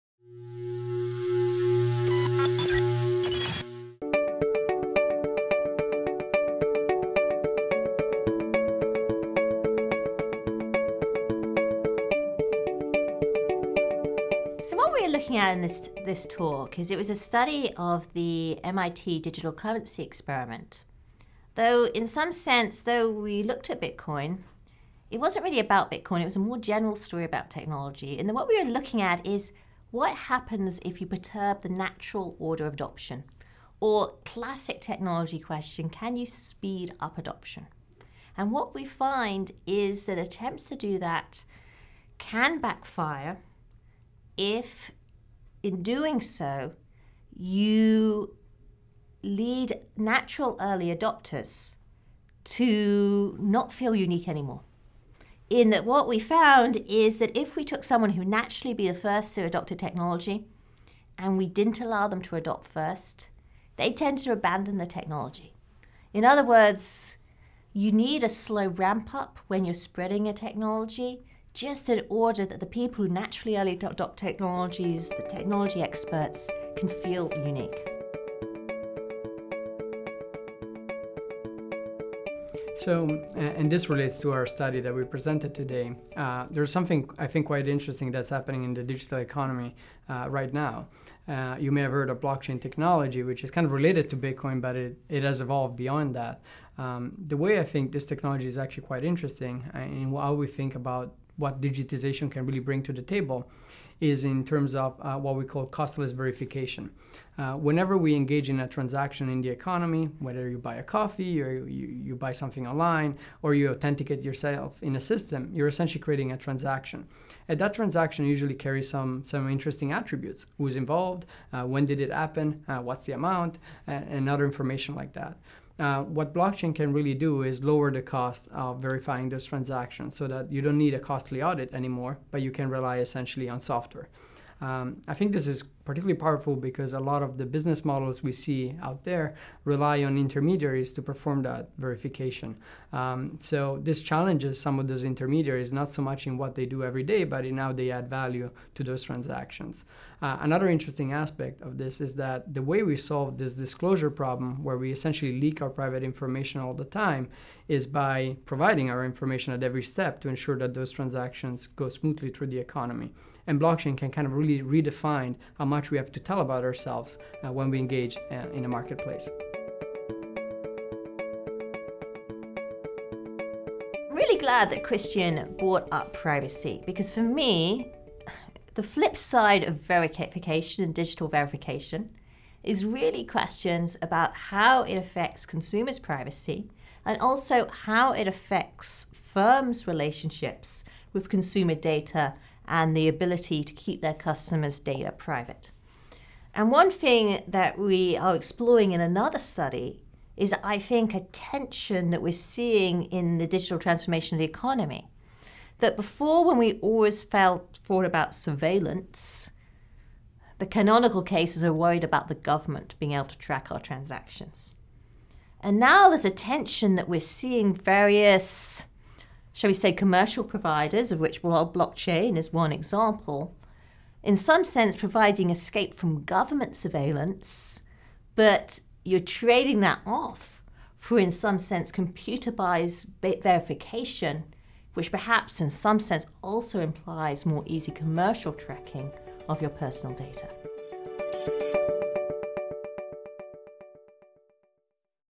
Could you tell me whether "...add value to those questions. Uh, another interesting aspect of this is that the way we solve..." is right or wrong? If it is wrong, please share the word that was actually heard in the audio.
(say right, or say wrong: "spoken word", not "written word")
wrong: "transactions", not "questions".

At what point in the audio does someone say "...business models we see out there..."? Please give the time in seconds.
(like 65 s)
137 s.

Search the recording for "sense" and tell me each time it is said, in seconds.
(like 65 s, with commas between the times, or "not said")
22 s, 224 s, 231 s, 235 s.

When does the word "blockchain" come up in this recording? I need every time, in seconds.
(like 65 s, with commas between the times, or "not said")
92 s, 126 s, 163 s, 221 s.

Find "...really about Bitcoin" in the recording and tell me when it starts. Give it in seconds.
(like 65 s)
25 s.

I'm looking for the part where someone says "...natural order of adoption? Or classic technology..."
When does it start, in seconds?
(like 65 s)
31 s.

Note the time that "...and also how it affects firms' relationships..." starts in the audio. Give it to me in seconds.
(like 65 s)
187 s.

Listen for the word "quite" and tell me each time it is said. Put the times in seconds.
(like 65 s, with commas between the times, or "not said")
87 s, 98 s.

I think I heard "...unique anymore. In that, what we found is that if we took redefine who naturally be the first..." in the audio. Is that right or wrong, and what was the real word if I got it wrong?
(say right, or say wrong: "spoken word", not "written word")
wrong: "someone", not "redefine".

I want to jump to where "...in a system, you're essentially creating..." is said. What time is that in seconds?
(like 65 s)
114 s.